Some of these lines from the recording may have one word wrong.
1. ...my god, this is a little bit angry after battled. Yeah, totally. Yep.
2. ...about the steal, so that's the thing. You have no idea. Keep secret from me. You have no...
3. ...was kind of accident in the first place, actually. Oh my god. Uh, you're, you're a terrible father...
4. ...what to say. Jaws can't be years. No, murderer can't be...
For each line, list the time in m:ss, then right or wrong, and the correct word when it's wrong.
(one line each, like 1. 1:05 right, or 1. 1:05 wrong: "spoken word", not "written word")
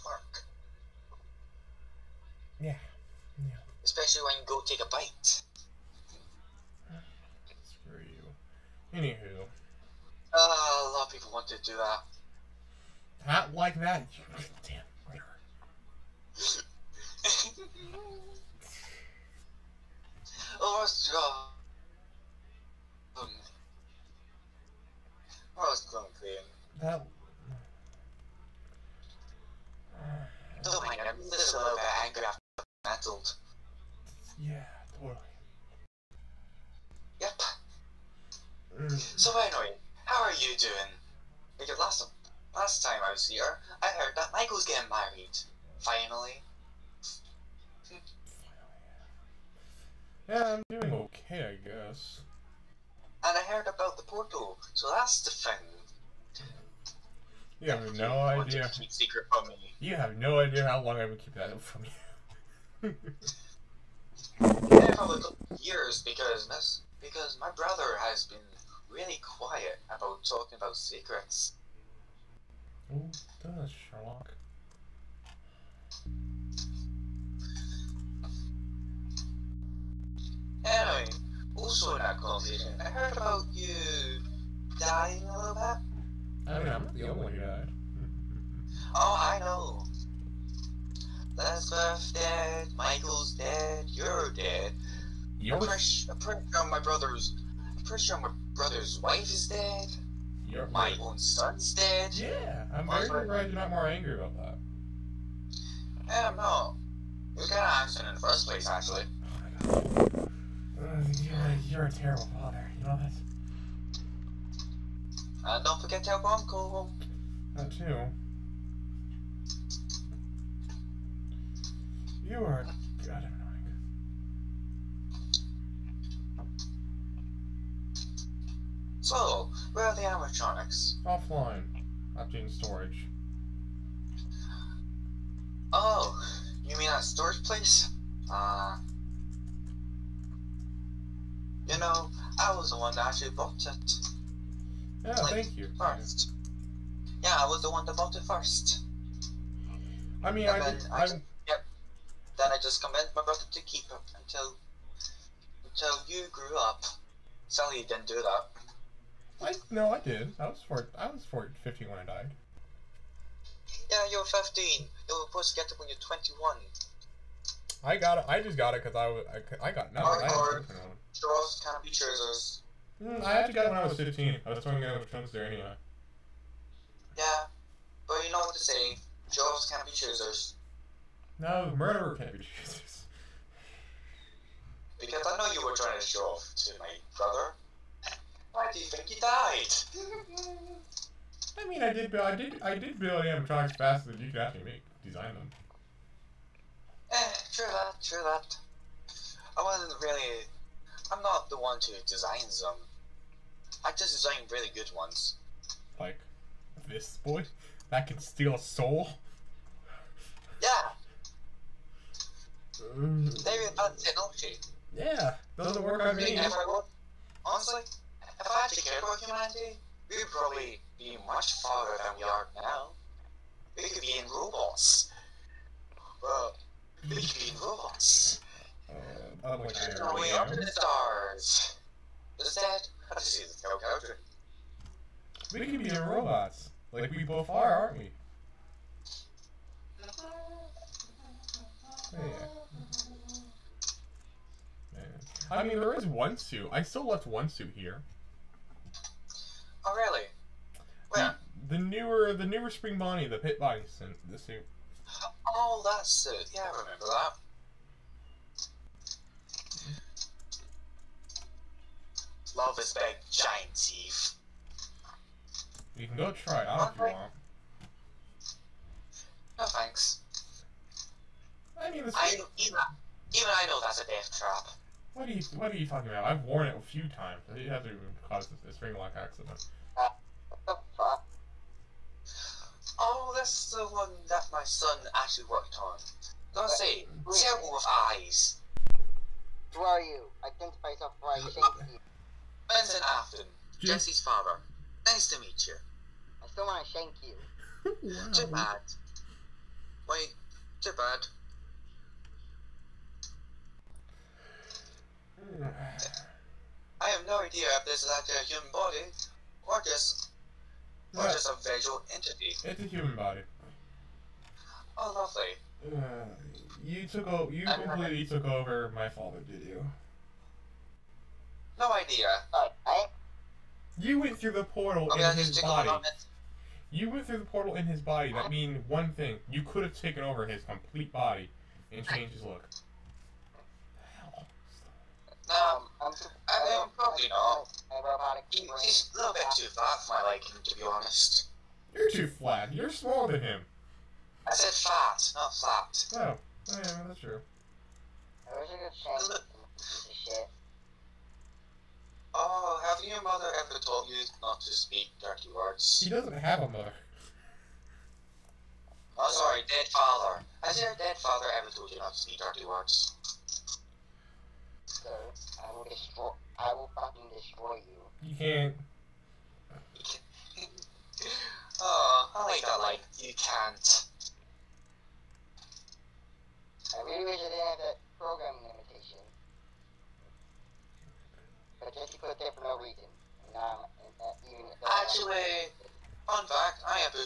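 1. 0:30 right
2. 0:53 wrong: "portal", not "steal"
3. 1:47 right
4. 2:58 wrong: "choosers", not "years".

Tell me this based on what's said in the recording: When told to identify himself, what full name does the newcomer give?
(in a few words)
Benson Afton.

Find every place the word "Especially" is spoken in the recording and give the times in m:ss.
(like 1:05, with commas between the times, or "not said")
0:03.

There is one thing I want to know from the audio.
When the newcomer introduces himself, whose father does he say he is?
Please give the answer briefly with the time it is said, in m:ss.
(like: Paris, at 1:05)
Jesse, at 4:53.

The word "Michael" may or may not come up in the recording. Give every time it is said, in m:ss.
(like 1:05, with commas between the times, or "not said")
0:44, 1:32.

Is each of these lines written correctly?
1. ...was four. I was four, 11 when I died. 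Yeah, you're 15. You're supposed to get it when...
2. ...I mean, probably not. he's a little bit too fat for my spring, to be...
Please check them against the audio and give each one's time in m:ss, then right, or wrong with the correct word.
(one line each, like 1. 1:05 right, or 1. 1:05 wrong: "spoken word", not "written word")
1. 2:40 wrong: "15", not "11"
2. 5:36 wrong: "liking", not "spring".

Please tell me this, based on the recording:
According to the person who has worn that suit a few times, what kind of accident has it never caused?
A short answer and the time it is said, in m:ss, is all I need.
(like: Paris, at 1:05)
Spring lock accident, at 4:38.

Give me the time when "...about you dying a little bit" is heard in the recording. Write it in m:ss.
1:23.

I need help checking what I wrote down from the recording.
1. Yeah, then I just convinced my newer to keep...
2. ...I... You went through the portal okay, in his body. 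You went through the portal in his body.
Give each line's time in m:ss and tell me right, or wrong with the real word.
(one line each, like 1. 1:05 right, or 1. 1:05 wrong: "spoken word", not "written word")
1. 2:31 wrong: "brother", not "newer"
2. 5:22 right.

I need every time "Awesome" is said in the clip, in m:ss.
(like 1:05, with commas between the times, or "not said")
0:20, 0:25.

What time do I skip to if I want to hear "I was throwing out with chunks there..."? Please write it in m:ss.
2:54.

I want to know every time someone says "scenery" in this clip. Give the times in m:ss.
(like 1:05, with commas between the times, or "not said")
not said.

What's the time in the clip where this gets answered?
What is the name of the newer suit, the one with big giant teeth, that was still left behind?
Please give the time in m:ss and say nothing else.
4:12.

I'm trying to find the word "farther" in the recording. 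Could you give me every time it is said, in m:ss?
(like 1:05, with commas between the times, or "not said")
3:41.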